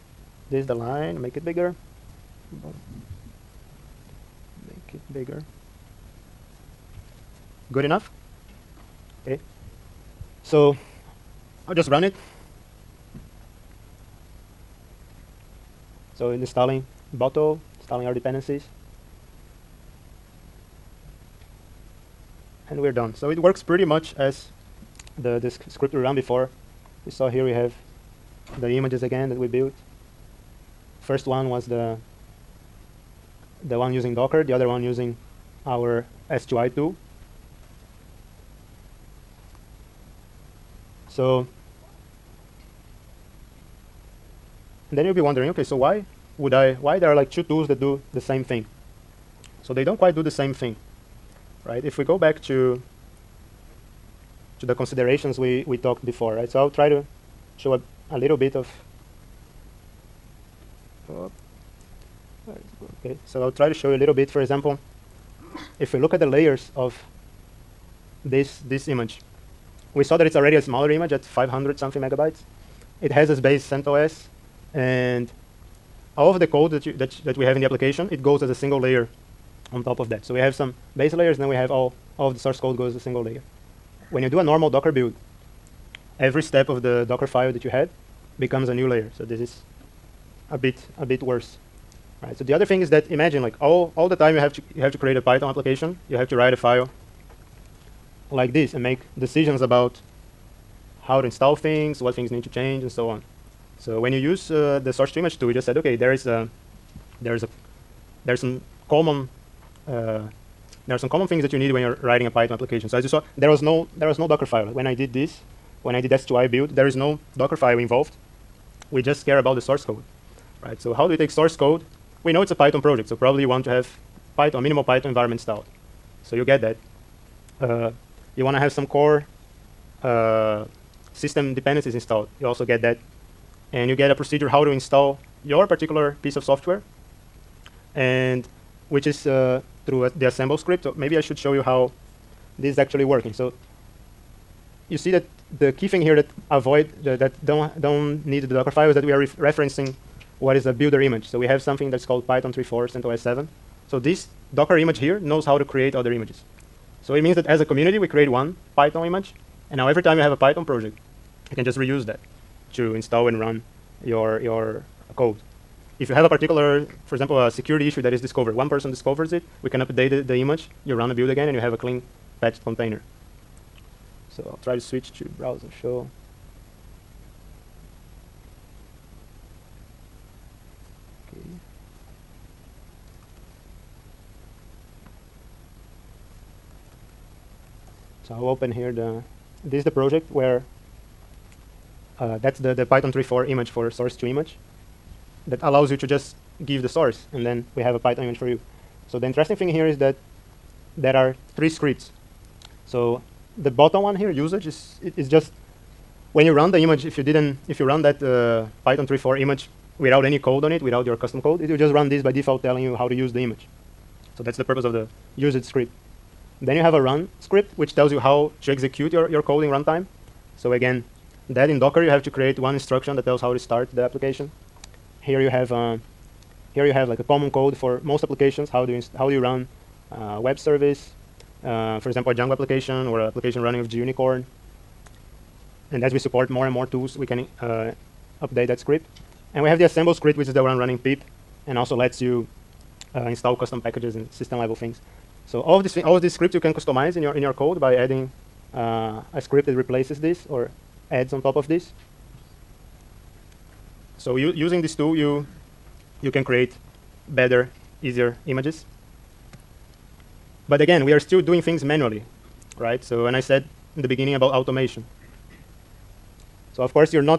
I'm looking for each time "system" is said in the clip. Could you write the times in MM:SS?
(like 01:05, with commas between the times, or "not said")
02:11, 04:04.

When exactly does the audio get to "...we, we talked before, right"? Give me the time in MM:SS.
00:55.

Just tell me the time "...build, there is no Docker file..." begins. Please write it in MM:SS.
01:56.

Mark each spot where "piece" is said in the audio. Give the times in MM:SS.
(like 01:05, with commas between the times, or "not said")
02:16.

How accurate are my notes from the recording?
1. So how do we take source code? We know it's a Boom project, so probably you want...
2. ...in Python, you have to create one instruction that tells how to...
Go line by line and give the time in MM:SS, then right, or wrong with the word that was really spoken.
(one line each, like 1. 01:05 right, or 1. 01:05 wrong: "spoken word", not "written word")
1. 02:00 wrong: "Python", not "Boom"
2. 03:41 wrong: "Docker", not "Python".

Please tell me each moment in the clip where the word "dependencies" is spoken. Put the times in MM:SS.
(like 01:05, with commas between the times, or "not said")
00:18, 02:11.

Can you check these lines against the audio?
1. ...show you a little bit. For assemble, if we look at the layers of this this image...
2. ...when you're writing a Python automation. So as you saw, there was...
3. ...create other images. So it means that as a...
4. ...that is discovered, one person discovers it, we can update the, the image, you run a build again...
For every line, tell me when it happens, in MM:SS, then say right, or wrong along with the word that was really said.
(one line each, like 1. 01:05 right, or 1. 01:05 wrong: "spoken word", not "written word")
1. 01:03 wrong: "example", not "assemble"
2. 01:51 wrong: "application", not "automation"
3. 02:35 right
4. 02:48 right.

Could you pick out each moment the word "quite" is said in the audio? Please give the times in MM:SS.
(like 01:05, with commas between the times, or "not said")
00:49.